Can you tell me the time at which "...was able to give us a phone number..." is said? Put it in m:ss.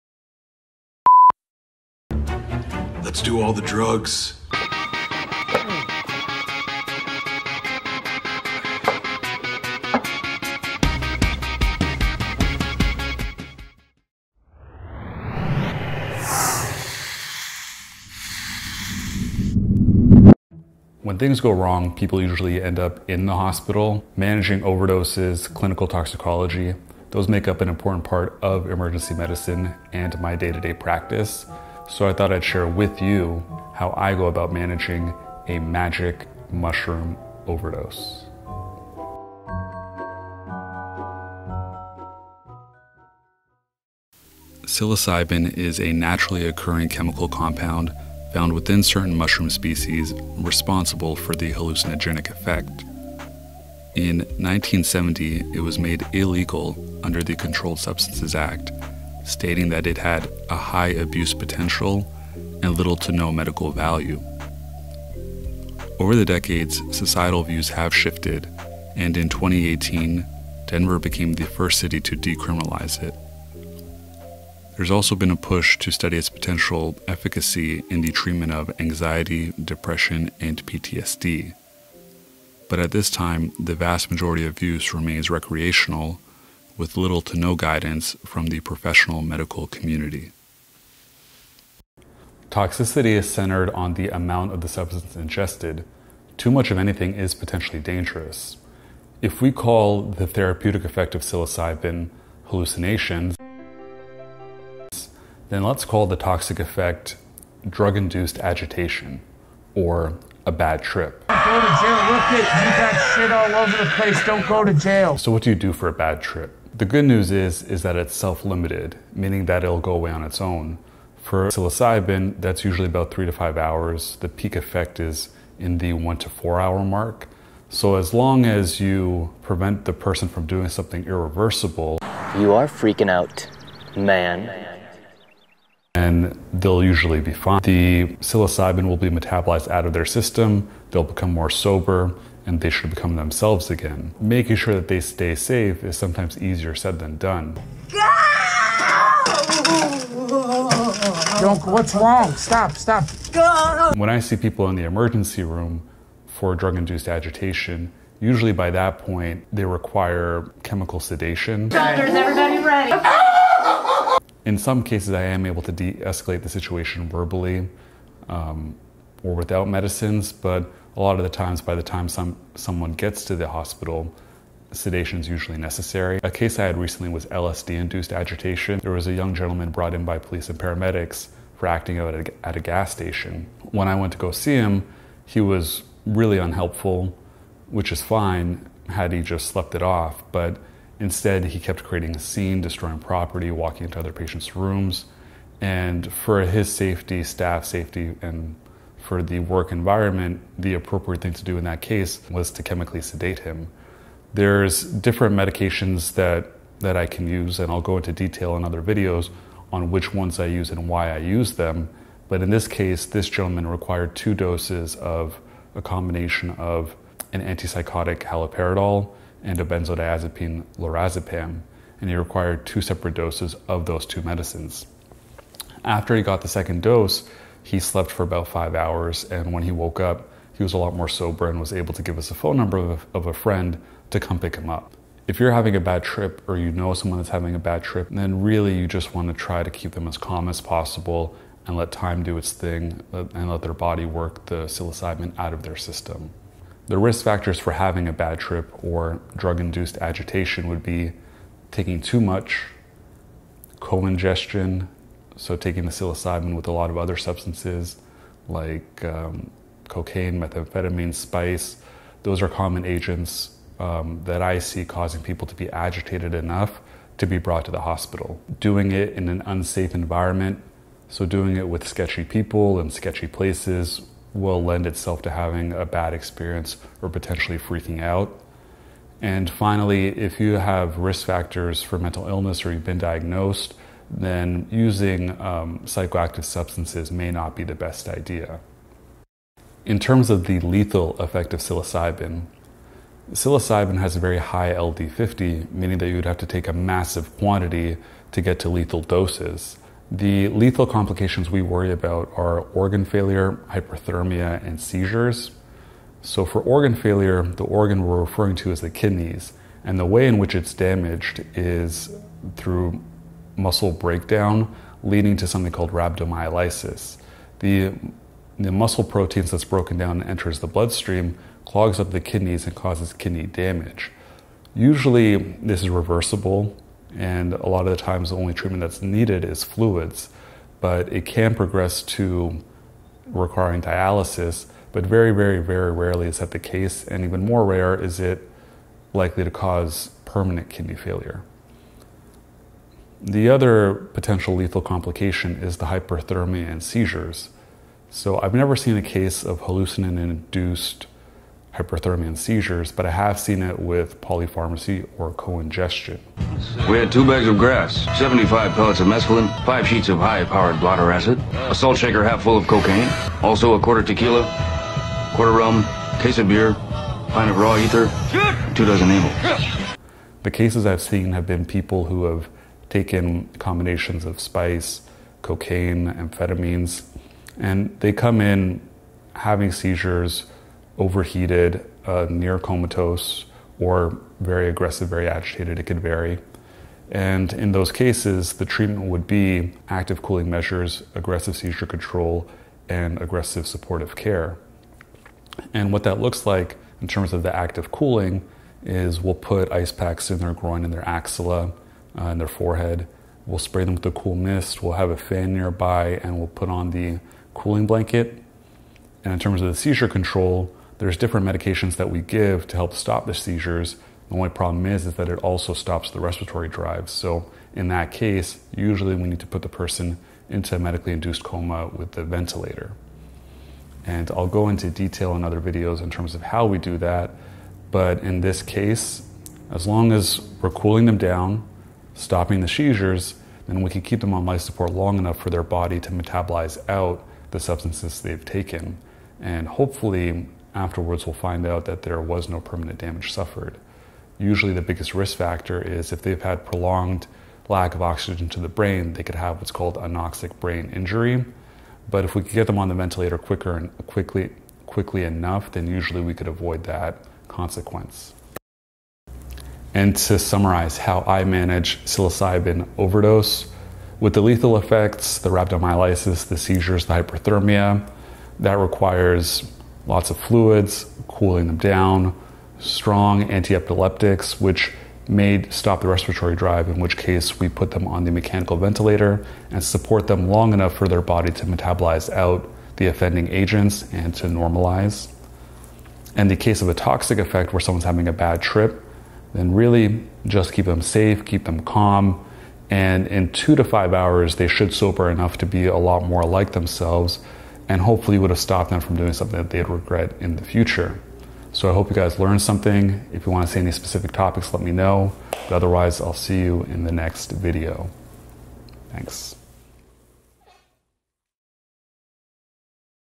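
3:51.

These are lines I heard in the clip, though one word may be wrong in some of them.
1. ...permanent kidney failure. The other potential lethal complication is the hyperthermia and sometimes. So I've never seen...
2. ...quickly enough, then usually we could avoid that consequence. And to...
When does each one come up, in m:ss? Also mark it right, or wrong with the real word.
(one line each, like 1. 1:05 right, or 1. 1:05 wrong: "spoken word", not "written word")
1. 5:40 wrong: "seizures", not "sometimes"
2. 7:34 right.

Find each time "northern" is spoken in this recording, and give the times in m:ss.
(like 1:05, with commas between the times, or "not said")
not said.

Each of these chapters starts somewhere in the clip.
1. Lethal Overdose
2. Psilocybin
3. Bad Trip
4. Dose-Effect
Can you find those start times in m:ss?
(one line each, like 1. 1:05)
1. 4:57
2. 0:52
3. 2:05
4. 1:41.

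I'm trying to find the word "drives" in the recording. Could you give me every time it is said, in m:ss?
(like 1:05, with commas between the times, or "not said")
6:56, 7:56.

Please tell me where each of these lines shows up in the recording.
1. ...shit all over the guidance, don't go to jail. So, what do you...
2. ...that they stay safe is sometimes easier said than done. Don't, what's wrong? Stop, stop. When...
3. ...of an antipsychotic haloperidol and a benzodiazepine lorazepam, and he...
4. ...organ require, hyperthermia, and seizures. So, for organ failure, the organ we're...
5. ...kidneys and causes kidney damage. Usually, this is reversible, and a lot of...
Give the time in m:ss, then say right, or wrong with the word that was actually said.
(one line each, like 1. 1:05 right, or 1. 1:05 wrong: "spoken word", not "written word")
1. 1:53 wrong: "place", not "guidance"
2. 2:24 right
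3. 3:36 right
4. 5:02 wrong: "failure", not "require"
5. 5:22 right.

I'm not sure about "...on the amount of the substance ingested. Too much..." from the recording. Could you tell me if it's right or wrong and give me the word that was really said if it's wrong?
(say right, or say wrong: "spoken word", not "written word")
right.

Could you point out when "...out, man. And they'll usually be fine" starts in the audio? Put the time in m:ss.
2:13.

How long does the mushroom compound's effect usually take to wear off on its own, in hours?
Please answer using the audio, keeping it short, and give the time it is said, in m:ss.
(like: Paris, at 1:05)
3 to 5 hours, at 2:03.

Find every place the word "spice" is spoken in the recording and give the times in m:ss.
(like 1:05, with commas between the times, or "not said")
4:21, 6:14.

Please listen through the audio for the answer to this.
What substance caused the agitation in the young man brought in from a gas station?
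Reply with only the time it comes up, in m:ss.
2:57.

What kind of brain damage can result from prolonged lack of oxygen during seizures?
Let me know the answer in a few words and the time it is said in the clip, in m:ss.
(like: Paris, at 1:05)
anoxic brain injury, at 7:29.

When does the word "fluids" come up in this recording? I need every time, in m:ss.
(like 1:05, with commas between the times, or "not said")
5:29, 7:50.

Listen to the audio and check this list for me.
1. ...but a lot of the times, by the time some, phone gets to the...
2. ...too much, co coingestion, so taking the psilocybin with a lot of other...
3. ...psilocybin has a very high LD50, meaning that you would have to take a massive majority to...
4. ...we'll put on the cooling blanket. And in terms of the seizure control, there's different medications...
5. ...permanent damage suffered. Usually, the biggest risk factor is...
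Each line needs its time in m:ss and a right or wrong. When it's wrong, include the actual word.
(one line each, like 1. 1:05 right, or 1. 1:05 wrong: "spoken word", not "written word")
1. 2:50 wrong: "someone", not "phone"
2. 4:12 wrong: "ingestion", not "coingestion"
3. 4:53 wrong: "quantity", not "majority"
4. 6:46 right
5. 7:22 right.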